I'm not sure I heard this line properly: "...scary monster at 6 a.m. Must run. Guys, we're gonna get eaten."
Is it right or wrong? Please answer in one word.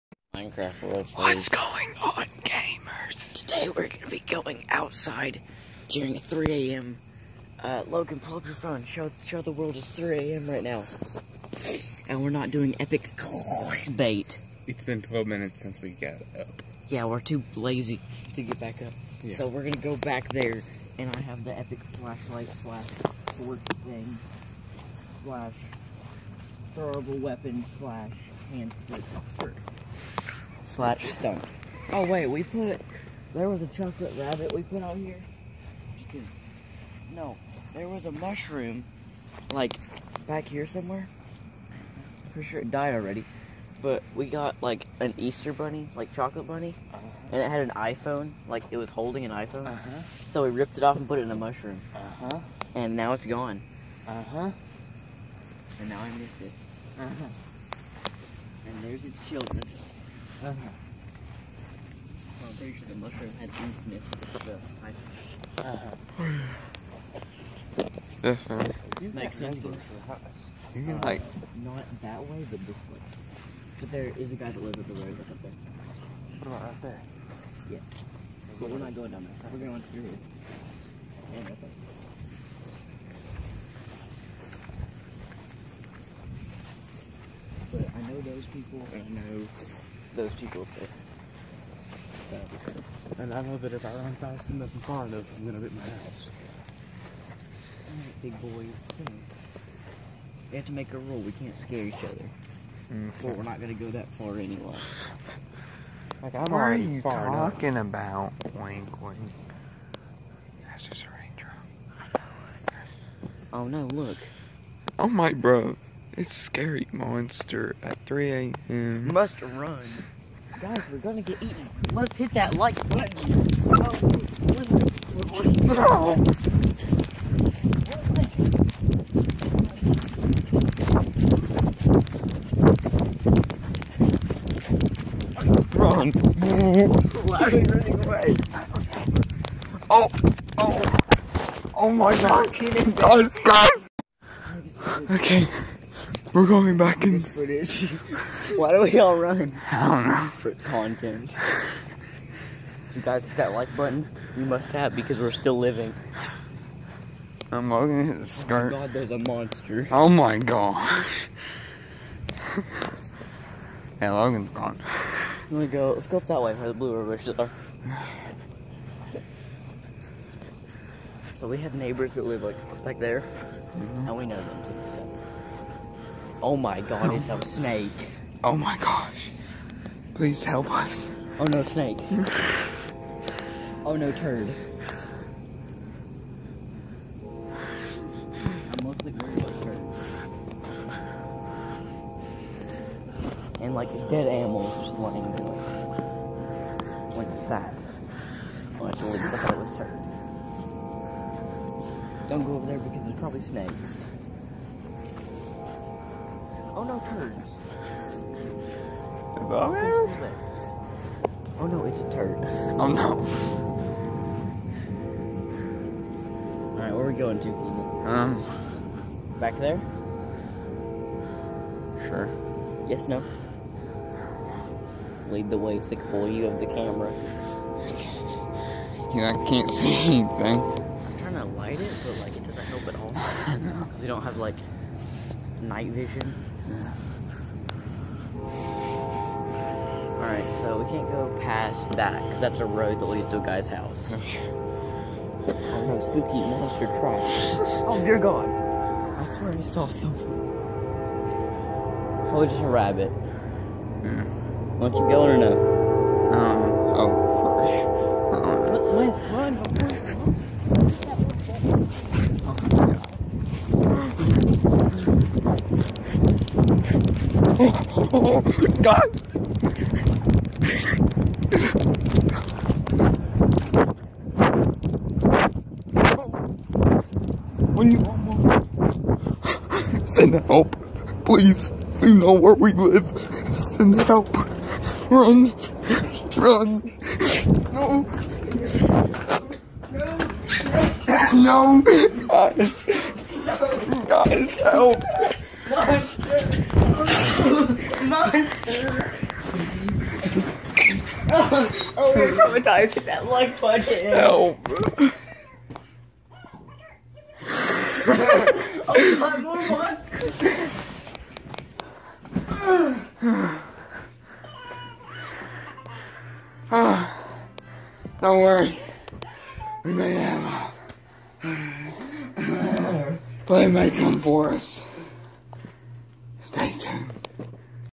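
wrong.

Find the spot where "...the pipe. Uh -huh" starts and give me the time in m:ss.
1:04.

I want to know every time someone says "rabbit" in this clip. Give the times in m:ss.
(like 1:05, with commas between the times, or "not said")
0:34, 4:12.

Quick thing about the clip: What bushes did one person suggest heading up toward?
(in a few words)
blue rivers bushes.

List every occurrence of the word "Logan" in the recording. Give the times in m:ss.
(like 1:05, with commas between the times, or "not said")
0:07, 2:44.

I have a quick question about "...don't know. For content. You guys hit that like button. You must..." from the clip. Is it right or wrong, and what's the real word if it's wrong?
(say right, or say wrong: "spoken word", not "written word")
right.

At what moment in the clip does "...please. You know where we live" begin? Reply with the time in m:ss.
4:41.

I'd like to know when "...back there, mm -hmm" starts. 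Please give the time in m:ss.
2:52.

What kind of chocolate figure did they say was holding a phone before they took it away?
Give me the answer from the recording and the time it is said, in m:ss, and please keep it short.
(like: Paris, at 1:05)
Easter bunny, at 0:45.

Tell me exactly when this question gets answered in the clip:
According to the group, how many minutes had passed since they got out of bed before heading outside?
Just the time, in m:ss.
0:15.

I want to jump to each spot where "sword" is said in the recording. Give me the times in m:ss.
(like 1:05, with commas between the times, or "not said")
0:23.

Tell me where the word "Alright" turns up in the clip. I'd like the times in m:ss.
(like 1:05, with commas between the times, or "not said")
3:36, 4:00.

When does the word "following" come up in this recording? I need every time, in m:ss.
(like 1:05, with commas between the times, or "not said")
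not said.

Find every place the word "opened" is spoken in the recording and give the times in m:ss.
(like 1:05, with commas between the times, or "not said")
not said.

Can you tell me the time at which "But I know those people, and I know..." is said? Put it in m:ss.
1:27.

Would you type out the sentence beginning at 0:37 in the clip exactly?
No, there was a mushroom, like, back here somewhere.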